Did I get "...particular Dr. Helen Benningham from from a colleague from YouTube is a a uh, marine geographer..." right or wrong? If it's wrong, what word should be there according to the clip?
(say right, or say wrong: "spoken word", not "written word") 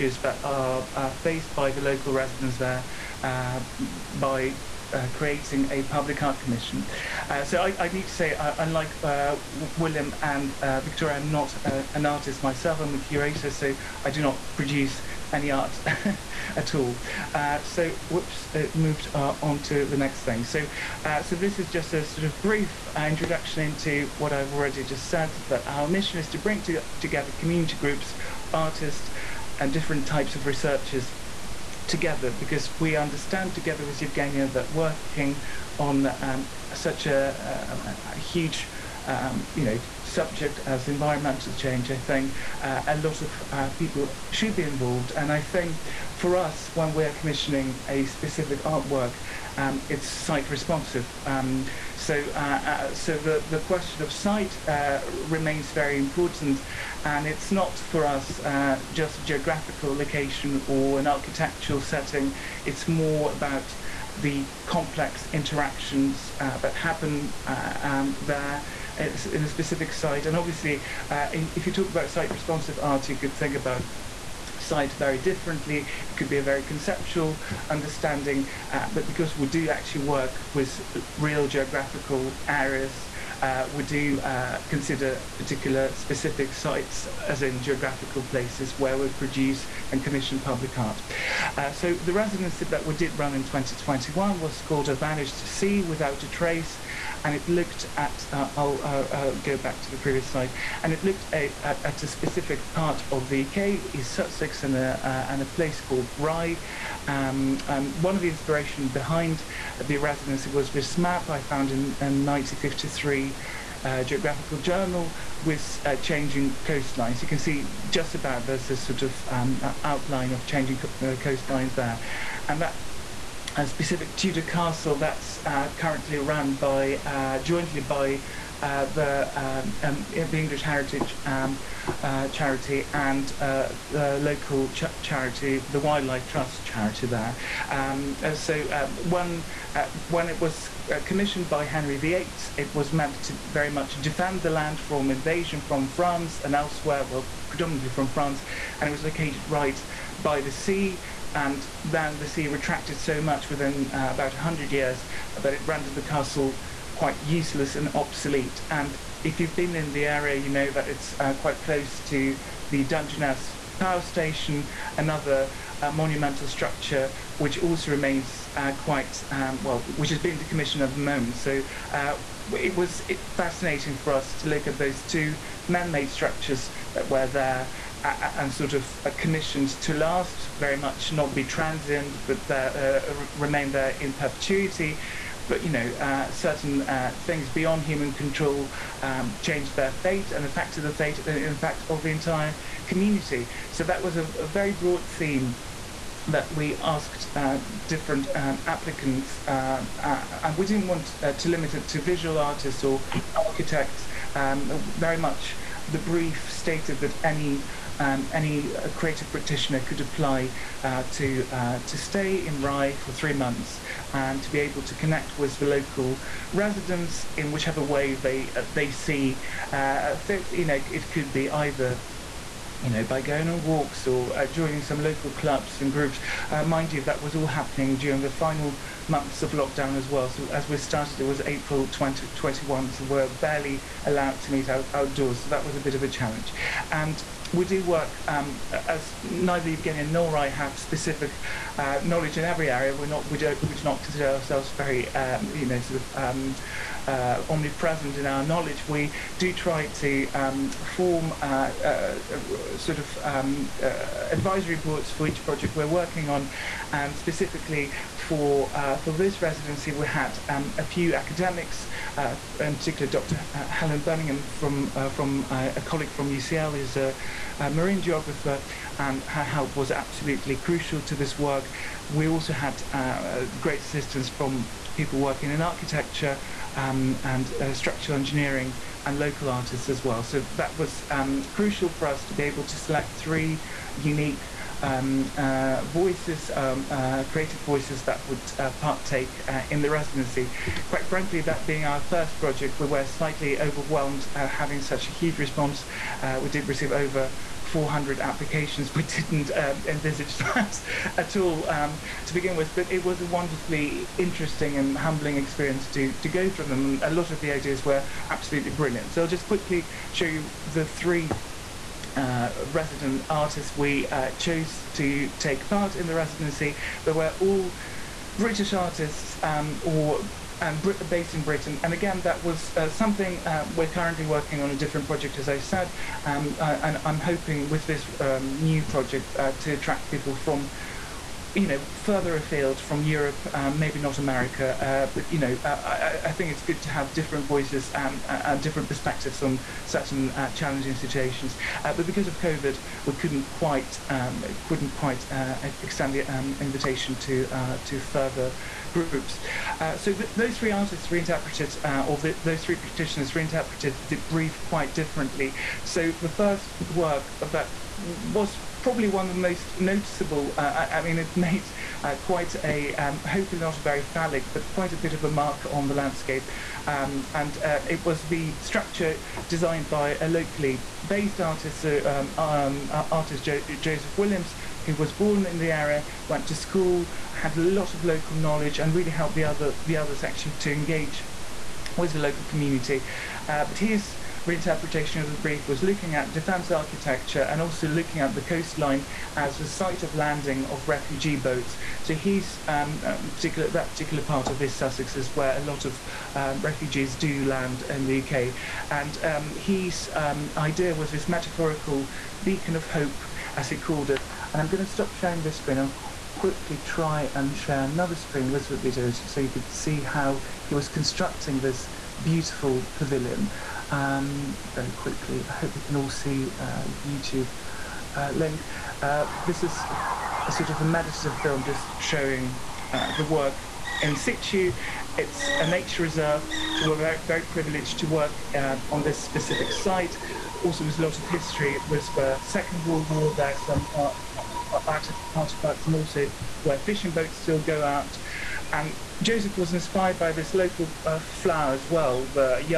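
wrong: "UCL", not "YouTube".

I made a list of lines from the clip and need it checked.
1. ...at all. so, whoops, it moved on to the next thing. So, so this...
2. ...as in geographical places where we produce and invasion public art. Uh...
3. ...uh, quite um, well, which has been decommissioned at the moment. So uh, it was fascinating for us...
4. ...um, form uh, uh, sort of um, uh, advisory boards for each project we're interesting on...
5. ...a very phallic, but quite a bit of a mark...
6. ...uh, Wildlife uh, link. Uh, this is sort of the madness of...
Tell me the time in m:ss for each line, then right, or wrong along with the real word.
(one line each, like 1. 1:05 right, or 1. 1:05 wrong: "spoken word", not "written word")
1. 0:16 right
2. 1:27 wrong: "commission", not "invasion"
3. 2:48 right
4. 4:10 wrong: "working", not "interesting"
5. 6:03 right
6. 6:56 wrong: "YouTube", not "Wildlife".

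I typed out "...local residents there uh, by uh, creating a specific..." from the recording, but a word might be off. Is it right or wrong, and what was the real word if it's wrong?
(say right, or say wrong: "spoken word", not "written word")
wrong: "public", not "specific".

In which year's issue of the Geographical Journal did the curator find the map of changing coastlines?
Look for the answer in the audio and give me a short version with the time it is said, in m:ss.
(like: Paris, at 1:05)
1953, at 1:52.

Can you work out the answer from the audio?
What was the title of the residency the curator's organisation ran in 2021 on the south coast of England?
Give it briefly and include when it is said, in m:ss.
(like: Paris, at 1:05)
A Vanished Sea Without a Trace, at 1:34.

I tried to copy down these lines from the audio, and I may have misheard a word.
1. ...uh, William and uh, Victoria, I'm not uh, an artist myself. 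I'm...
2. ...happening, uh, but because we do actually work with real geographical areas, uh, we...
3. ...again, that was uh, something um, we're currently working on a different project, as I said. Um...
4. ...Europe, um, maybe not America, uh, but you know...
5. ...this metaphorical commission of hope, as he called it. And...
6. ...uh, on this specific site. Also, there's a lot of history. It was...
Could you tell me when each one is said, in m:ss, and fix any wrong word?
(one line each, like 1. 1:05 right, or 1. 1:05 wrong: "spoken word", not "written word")
1. 0:09 right
2. 1:17 wrong: "understanding", not "happening"
3. 5:21 right
4. 5:33 right
5. 6:41 wrong: "beacon", not "commission"
6. 7:08 right.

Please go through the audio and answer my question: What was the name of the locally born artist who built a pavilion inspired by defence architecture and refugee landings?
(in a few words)
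Joseph Williams.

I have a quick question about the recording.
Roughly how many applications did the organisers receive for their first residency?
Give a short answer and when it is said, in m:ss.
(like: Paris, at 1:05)
over 400, at 4:56.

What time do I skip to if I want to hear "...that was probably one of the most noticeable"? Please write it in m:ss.
5:57.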